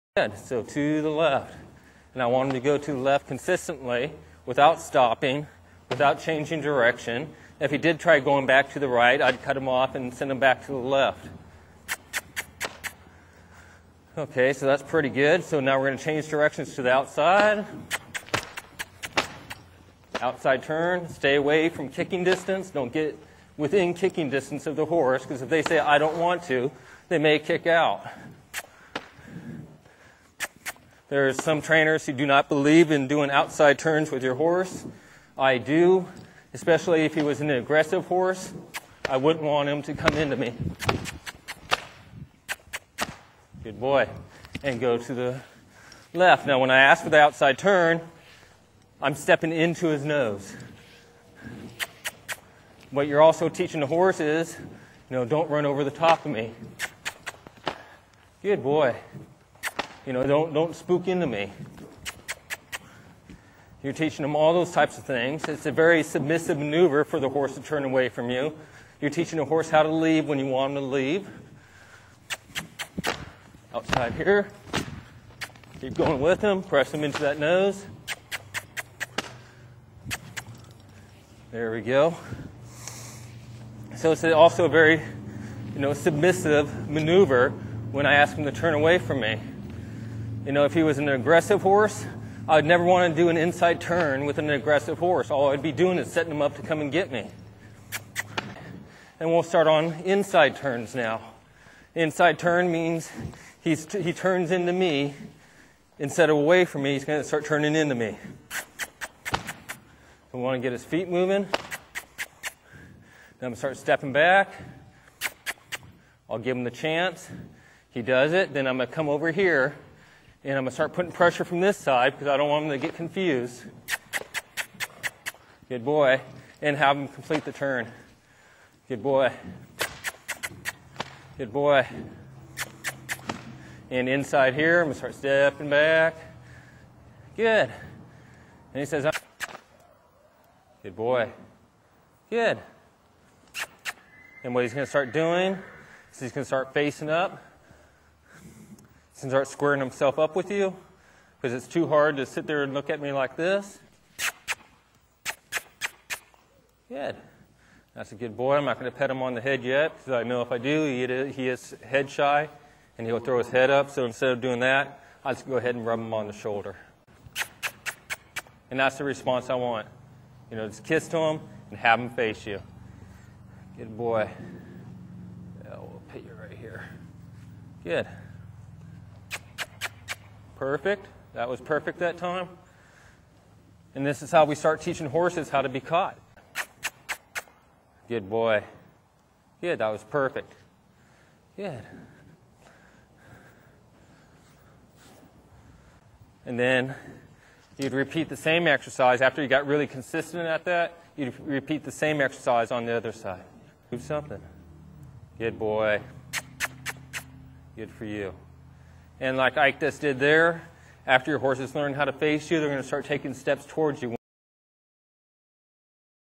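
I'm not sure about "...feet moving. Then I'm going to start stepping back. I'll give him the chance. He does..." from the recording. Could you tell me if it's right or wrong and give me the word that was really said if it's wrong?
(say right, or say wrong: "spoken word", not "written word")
right.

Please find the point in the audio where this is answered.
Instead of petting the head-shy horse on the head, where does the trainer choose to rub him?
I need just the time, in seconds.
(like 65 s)
166 s.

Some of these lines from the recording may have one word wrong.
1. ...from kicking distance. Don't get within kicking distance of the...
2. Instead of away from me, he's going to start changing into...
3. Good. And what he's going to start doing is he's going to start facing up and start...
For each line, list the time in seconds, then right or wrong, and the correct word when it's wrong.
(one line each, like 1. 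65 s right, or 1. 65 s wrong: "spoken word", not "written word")
1. 21 s right
2. 105 s wrong: "turning", not "changing"
3. 142 s right.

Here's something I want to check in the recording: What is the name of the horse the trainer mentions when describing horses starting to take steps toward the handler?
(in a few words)
Ike.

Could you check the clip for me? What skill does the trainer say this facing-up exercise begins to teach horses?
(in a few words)
How to be caught.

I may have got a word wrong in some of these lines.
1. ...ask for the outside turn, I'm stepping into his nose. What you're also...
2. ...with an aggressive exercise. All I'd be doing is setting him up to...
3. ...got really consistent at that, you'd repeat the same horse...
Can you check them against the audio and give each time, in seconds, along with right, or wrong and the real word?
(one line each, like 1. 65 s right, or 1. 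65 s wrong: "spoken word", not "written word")
1. 46 s right
2. 94 s wrong: "horse", not "exercise"
3. 199 s wrong: "exercise", not "horse".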